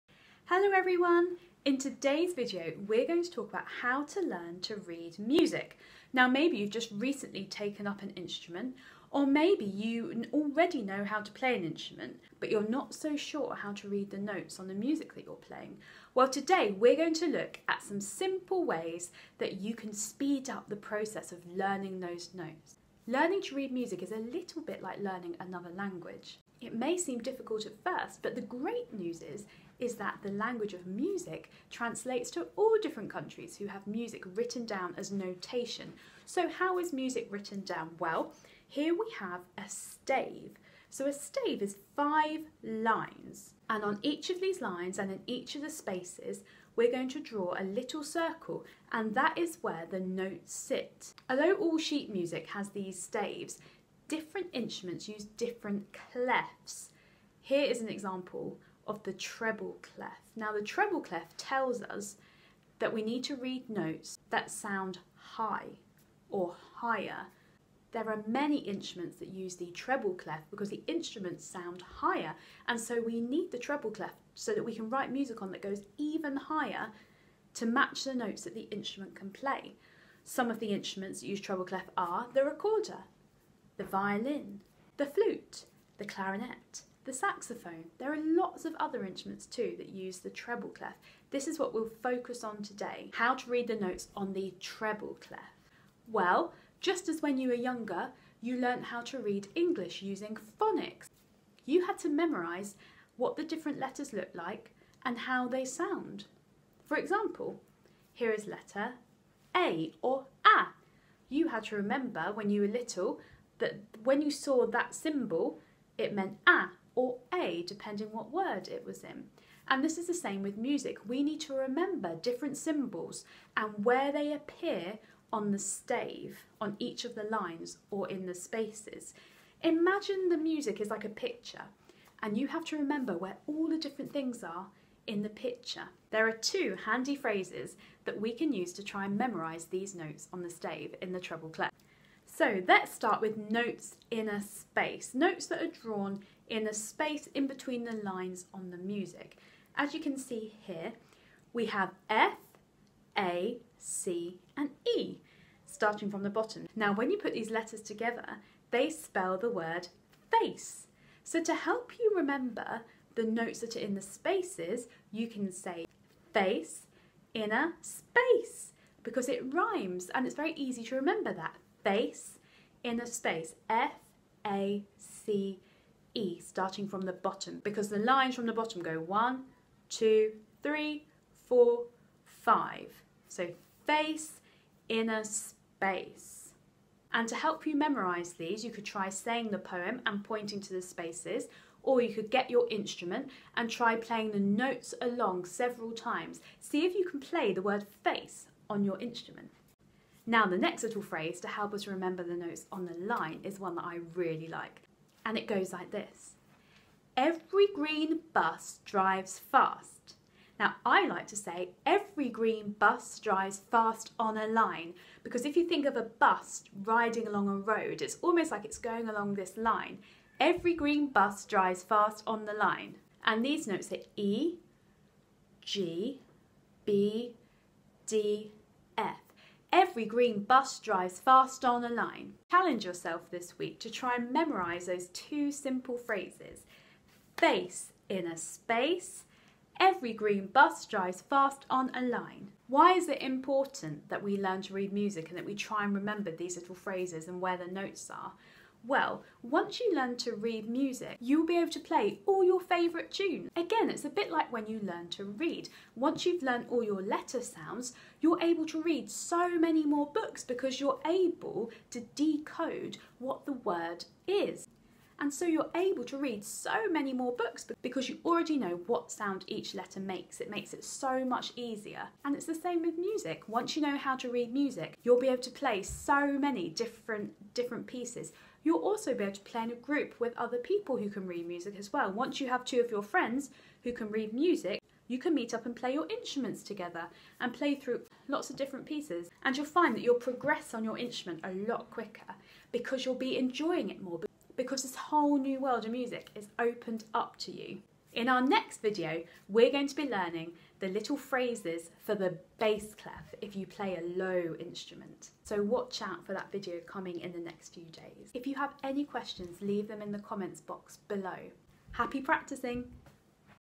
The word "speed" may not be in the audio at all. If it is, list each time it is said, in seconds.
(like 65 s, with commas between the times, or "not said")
19 s.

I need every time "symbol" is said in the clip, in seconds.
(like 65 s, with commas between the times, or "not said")
114 s, 122 s.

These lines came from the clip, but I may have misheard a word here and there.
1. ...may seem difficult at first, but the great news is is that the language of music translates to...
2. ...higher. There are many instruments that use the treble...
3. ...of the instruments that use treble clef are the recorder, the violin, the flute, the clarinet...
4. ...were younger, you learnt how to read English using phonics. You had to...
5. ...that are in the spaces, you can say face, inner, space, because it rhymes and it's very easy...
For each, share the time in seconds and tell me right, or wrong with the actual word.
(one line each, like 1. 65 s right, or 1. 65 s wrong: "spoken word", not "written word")
1. 26 s right
2. 66 s right
3. 80 s right
4. 97 s right
5. 163 s right.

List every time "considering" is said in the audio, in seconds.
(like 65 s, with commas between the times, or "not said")
not said.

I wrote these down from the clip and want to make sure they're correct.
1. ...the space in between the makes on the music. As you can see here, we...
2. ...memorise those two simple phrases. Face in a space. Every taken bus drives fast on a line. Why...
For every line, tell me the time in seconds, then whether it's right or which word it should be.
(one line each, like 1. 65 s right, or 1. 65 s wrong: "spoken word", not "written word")
1. 146 s wrong: "lines", not "makes"
2. 234 s wrong: "green", not "taken".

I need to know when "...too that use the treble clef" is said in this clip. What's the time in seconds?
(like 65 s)
89 s.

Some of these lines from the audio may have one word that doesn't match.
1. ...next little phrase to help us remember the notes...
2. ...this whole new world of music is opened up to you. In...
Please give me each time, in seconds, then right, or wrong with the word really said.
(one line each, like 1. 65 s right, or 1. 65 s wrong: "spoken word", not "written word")
1. 200 s right
2. 294 s right.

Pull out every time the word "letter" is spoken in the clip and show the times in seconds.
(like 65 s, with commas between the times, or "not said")
103 s, 108 s, 157 s, 257 s, 269 s.